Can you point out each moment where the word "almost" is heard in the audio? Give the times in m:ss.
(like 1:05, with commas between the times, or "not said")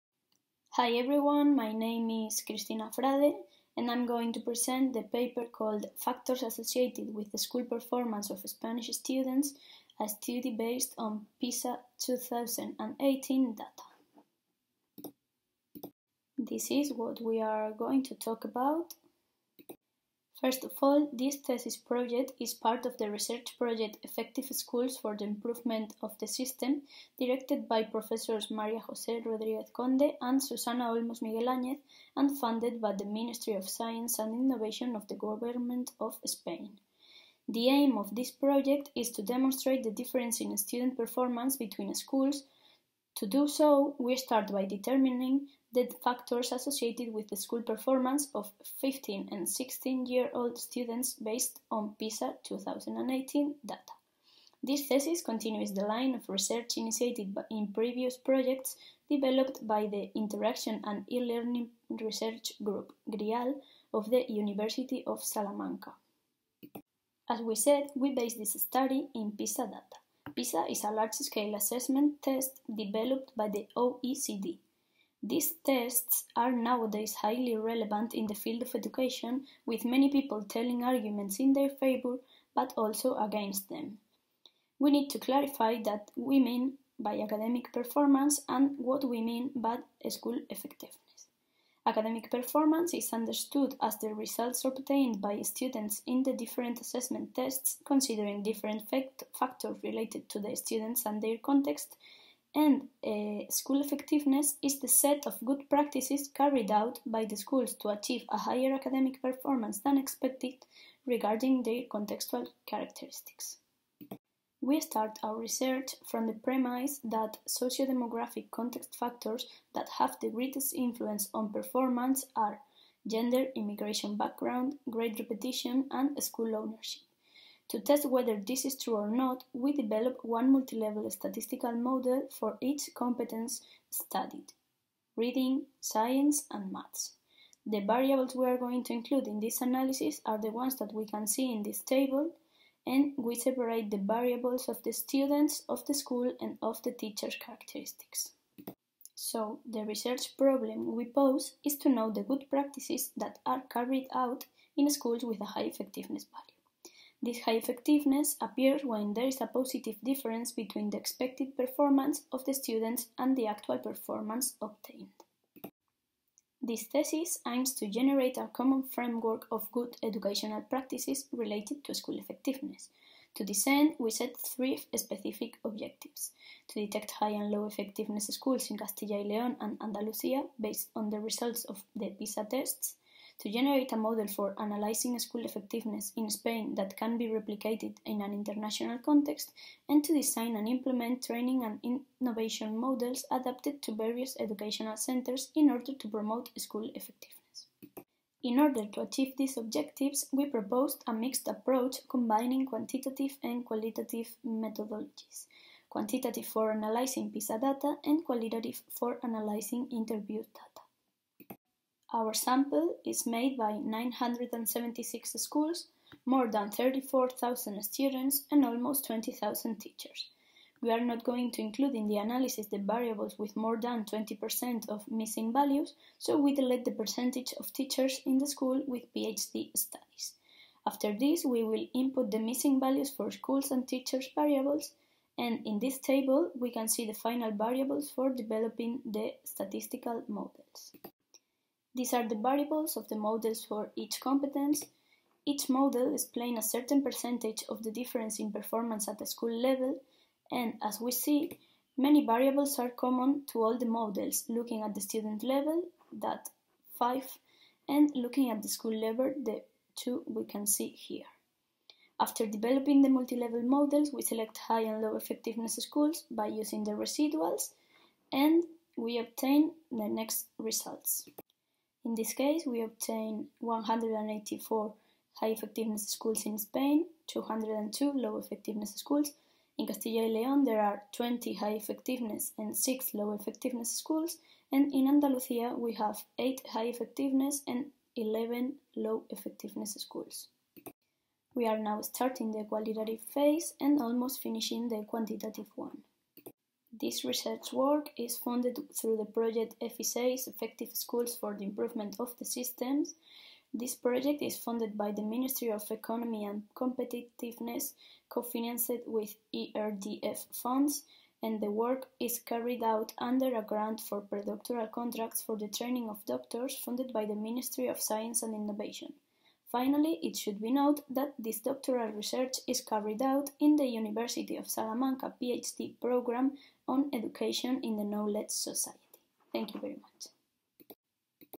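3:38, 4:54.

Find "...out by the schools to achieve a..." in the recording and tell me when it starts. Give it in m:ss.
1:46.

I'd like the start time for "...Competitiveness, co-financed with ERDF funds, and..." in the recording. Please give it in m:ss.
5:06.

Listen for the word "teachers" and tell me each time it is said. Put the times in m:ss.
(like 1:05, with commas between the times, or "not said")
2:26, 3:39, 3:47, 3:53.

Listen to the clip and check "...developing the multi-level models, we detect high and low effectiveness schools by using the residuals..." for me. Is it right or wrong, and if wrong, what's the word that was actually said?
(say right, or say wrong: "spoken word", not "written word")
wrong: "select", not "detect".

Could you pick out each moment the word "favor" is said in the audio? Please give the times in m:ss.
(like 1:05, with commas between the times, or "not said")
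1:21.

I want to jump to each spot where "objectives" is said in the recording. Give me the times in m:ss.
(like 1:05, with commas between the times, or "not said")
2:55, 3:19.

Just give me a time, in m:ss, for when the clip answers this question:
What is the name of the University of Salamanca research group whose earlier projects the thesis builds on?
1:03.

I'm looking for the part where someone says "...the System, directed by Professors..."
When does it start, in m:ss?
0:26.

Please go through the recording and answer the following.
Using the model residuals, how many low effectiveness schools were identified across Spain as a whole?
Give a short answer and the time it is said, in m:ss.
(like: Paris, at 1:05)
202, at 4:37.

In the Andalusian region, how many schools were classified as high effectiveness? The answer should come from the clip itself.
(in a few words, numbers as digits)
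8.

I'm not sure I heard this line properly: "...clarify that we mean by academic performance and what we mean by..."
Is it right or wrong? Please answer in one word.
right.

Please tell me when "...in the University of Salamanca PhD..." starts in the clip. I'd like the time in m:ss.
5:23.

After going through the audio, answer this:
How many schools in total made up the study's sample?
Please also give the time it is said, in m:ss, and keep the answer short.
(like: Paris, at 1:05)
976, at 3:33.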